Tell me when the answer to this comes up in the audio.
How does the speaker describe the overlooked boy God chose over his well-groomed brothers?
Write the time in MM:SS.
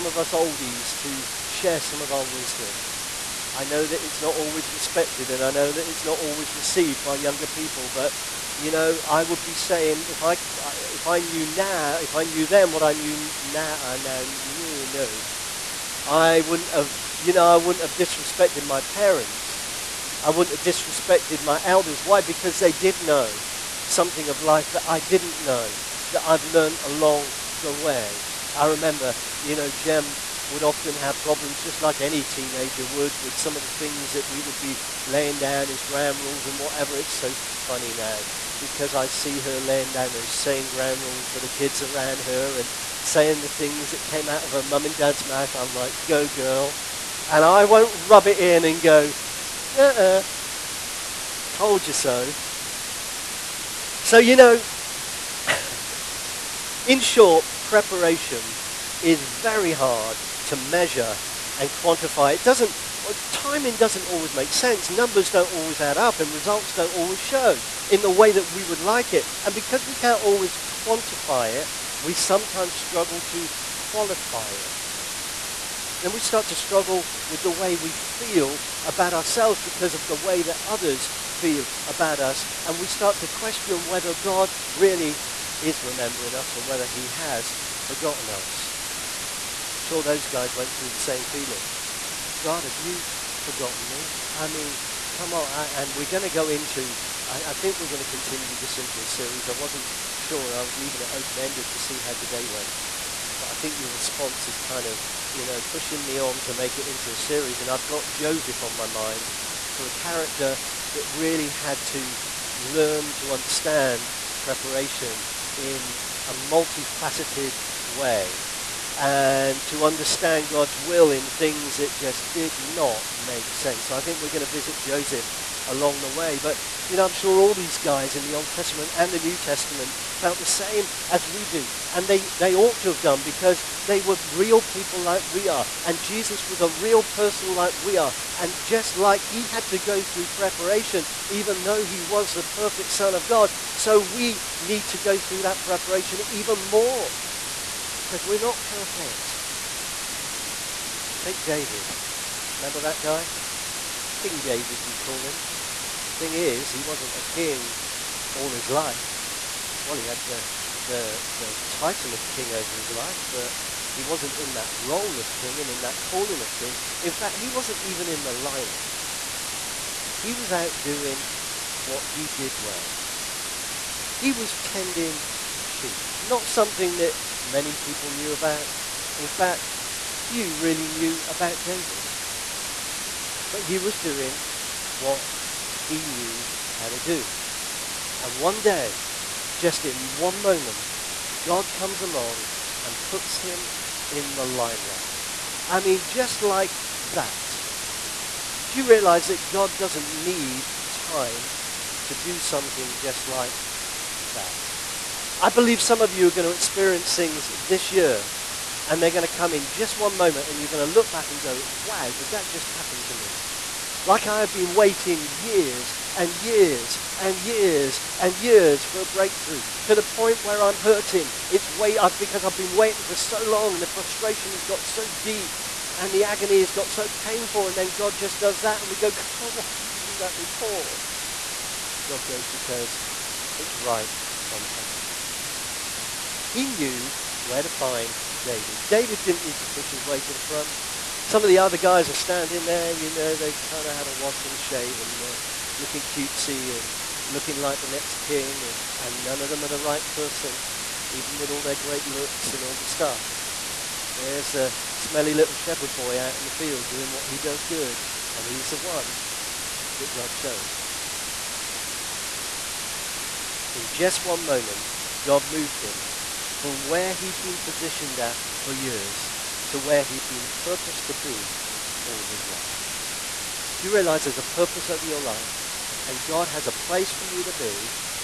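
04:14.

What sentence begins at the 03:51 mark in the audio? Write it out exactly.
And God goes, because it's right on time.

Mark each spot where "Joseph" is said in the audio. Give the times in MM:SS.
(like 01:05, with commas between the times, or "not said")
01:48, 02:04.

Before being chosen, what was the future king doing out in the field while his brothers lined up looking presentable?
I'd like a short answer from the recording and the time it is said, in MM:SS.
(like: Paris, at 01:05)
Tending sheep, at 02:54.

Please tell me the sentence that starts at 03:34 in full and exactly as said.
like I have been waiting years and years and years and years for a breakthrough to the point where I'm hurting.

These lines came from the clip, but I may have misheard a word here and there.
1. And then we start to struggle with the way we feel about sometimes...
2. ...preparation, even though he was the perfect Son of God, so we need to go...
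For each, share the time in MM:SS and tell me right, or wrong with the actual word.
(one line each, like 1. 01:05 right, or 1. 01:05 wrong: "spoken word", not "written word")
1. 01:15 wrong: "ourselves", not "sometimes"
2. 02:20 right.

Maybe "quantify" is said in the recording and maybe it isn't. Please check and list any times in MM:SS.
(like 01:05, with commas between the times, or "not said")
01:01, 01:10.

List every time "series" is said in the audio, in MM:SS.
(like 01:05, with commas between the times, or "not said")
01:39, 01:47.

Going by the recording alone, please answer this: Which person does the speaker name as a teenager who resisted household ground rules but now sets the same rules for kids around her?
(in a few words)
Jem.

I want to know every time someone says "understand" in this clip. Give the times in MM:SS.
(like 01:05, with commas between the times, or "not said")
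01:53, 01:59.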